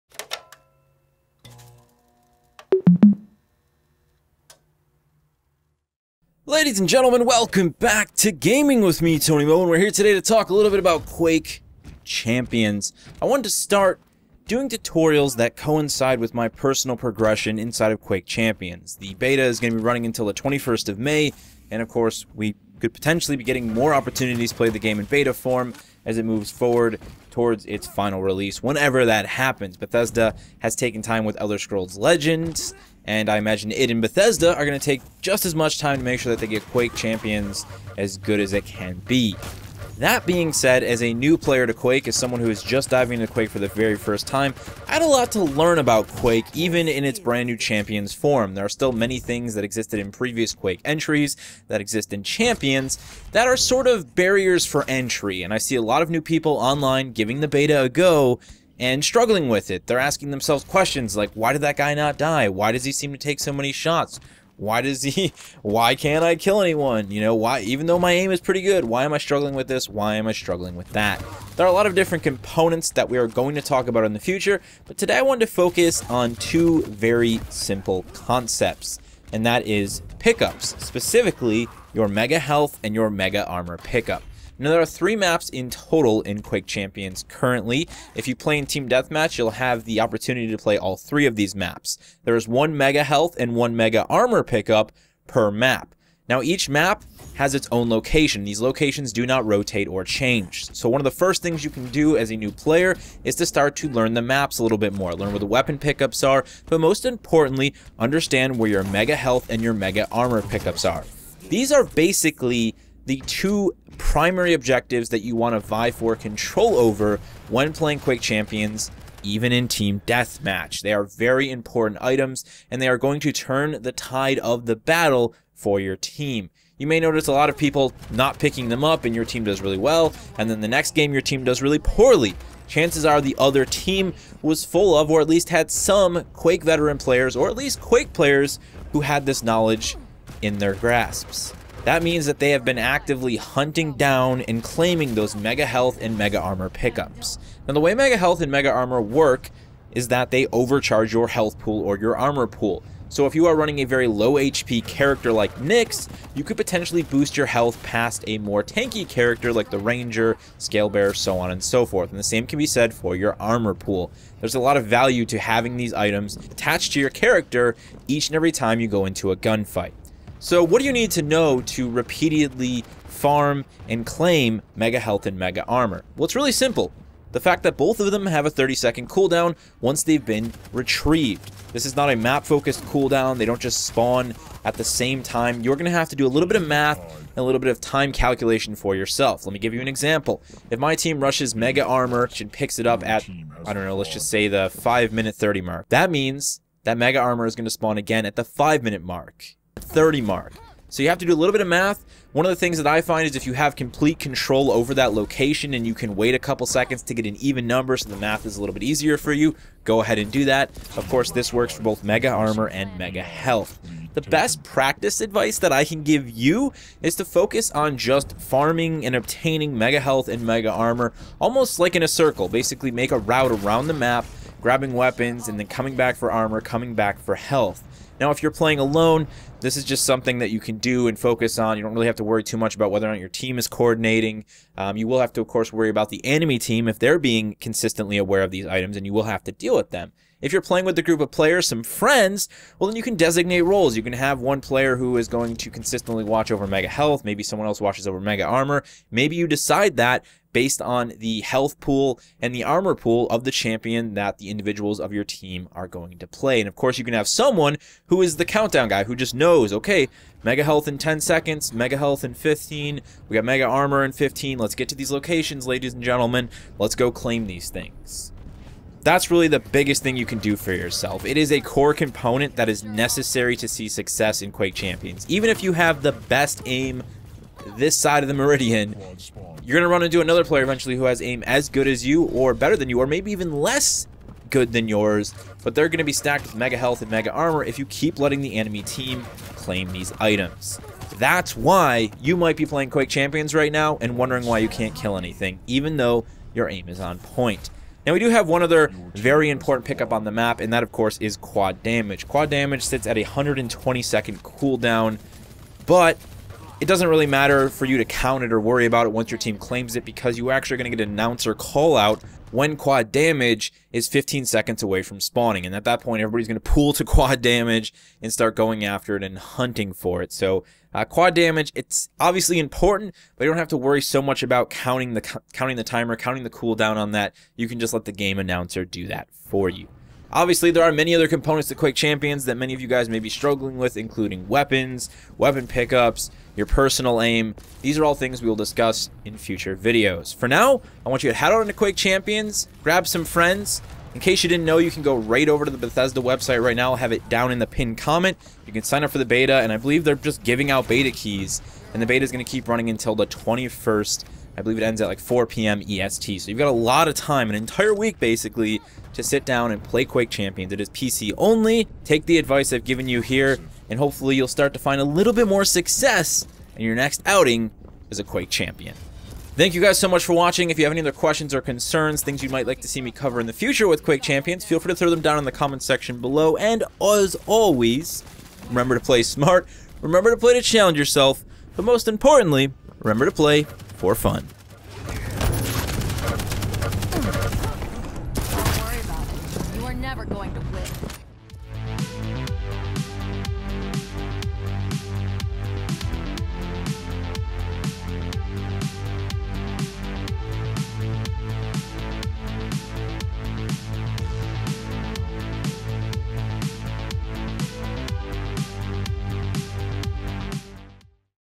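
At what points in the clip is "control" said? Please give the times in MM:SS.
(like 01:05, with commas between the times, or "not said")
01:56, 03:24.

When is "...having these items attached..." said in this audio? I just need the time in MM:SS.
02:45.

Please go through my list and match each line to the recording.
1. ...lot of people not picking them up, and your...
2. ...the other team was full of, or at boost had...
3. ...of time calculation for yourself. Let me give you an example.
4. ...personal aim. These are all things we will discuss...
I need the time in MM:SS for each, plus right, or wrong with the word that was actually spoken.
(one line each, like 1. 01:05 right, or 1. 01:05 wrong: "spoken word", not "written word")
1. 02:07 right
2. 02:13 wrong: "least", not "boost"
3. 03:07 right
4. 05:36 right.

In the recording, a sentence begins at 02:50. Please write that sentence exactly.
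So what do you need to know to repeatedly farm and claim Mega Health and Mega Armor?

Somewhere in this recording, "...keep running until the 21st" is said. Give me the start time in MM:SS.
05:52.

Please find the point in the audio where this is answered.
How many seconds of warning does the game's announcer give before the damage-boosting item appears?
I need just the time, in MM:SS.
05:14.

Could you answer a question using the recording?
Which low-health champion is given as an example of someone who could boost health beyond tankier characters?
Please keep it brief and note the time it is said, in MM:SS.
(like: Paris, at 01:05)
Nyx, at 02:35.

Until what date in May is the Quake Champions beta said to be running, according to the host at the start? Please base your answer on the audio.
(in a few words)
21st of May.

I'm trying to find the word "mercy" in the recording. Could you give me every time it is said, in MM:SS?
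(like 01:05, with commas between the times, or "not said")
not said.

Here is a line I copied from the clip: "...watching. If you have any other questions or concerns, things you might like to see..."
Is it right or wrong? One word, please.
right.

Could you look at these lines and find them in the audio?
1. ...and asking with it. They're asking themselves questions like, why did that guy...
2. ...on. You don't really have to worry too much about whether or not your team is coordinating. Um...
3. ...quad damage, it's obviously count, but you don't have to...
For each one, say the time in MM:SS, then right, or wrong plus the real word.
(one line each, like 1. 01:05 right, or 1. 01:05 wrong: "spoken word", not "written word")
1. 00:58 wrong: "struggling", not "asking"
2. 03:51 right
3. 05:21 wrong: "important", not "count".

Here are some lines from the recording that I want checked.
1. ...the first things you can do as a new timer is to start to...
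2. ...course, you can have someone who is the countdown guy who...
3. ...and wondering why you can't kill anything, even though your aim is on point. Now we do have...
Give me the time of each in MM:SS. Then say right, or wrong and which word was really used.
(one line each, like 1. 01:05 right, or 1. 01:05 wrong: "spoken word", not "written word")
1. 01:41 wrong: "player", not "timer"
2. 04:16 right
3. 04:53 right.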